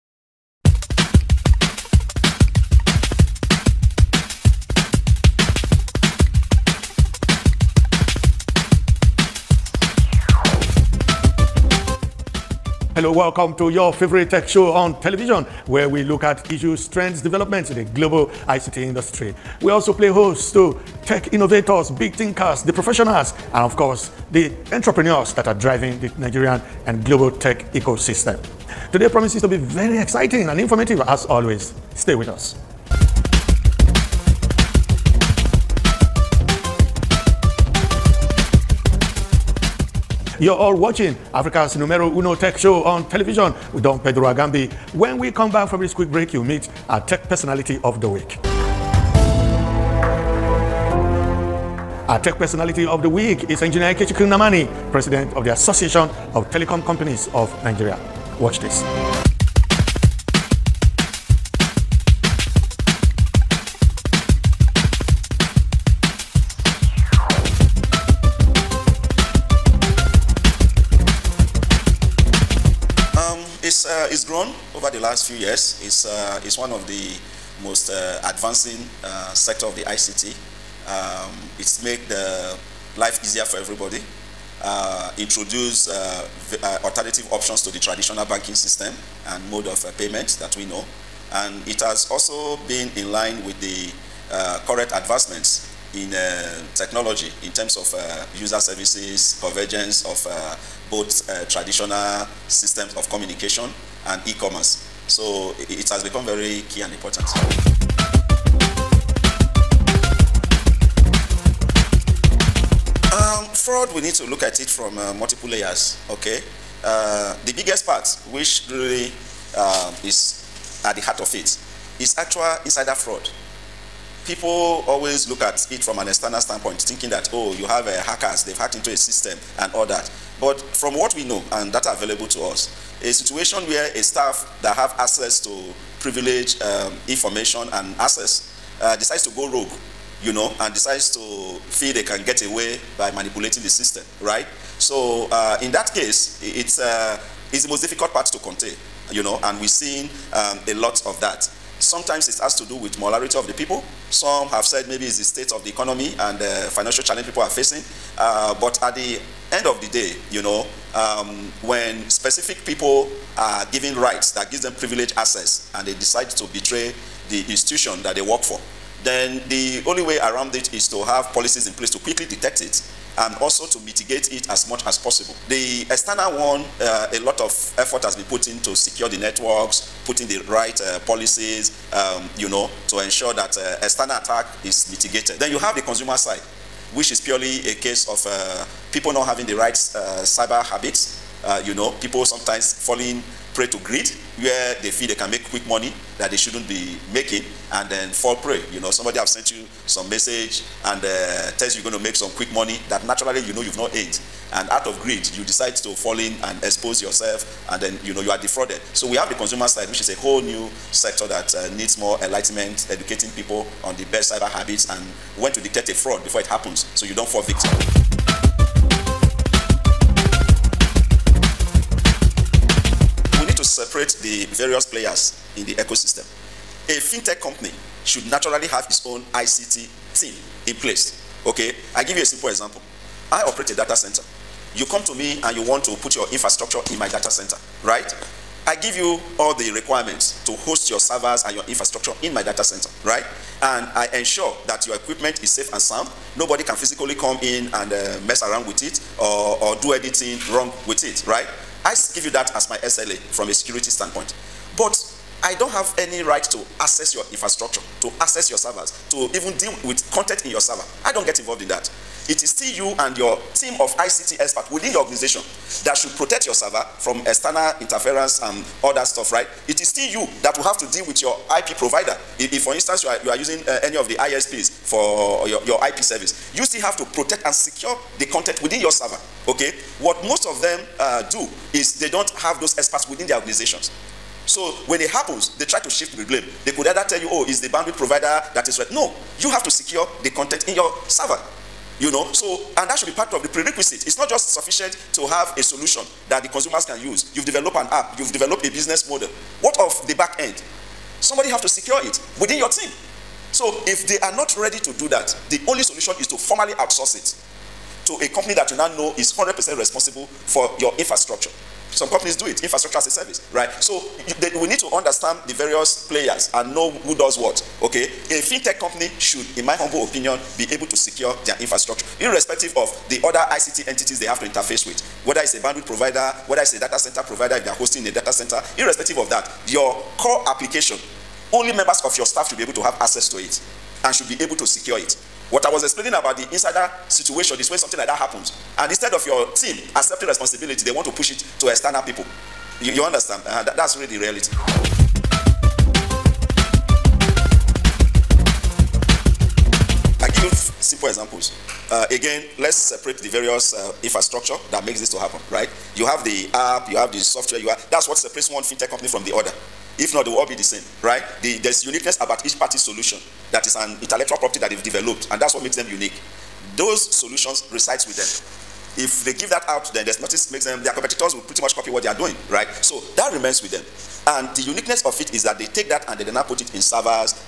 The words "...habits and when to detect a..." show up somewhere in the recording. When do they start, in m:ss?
3:34.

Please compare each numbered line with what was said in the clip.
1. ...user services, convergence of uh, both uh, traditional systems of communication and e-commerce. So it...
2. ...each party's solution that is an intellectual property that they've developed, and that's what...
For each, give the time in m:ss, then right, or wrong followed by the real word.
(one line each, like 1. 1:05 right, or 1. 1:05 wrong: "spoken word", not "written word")
1. 1:38 right
2. 6:02 right.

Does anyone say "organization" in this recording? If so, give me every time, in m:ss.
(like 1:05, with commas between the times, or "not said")
4:25, 4:43.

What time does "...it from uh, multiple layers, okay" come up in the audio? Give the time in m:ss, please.
1:54.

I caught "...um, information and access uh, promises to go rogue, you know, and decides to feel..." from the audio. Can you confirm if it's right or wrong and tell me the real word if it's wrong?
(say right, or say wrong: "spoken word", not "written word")
wrong: "decides", not "promises".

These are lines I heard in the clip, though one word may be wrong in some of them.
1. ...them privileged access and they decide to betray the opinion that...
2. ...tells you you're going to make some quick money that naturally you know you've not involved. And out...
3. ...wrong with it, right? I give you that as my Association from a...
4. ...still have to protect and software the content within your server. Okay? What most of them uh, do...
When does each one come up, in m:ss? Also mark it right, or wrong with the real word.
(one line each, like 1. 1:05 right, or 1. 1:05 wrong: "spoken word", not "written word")
1. 2:44 wrong: "institution", not "opinion"
2. 3:21 wrong: "earned", not "involved"
3. 4:10 wrong: "SLA", not "Association"
4. 4:36 wrong: "secure", not "software".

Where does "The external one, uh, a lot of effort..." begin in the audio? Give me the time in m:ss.
2:55.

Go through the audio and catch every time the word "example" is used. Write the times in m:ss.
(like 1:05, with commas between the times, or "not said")
3:52, 5:51.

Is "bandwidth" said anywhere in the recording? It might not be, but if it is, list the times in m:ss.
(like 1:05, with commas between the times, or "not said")
4:47, 5:25.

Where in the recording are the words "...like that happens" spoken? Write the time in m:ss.
5:37.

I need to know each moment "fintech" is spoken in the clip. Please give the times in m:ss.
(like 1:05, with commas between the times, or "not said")
3:46, 5:18, 5:58.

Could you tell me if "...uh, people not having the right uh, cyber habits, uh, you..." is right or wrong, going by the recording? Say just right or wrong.
right.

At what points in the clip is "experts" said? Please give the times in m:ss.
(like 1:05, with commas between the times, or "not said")
4:24, 4:42.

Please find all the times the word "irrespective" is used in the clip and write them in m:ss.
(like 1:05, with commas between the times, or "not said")
5:22, 5:28.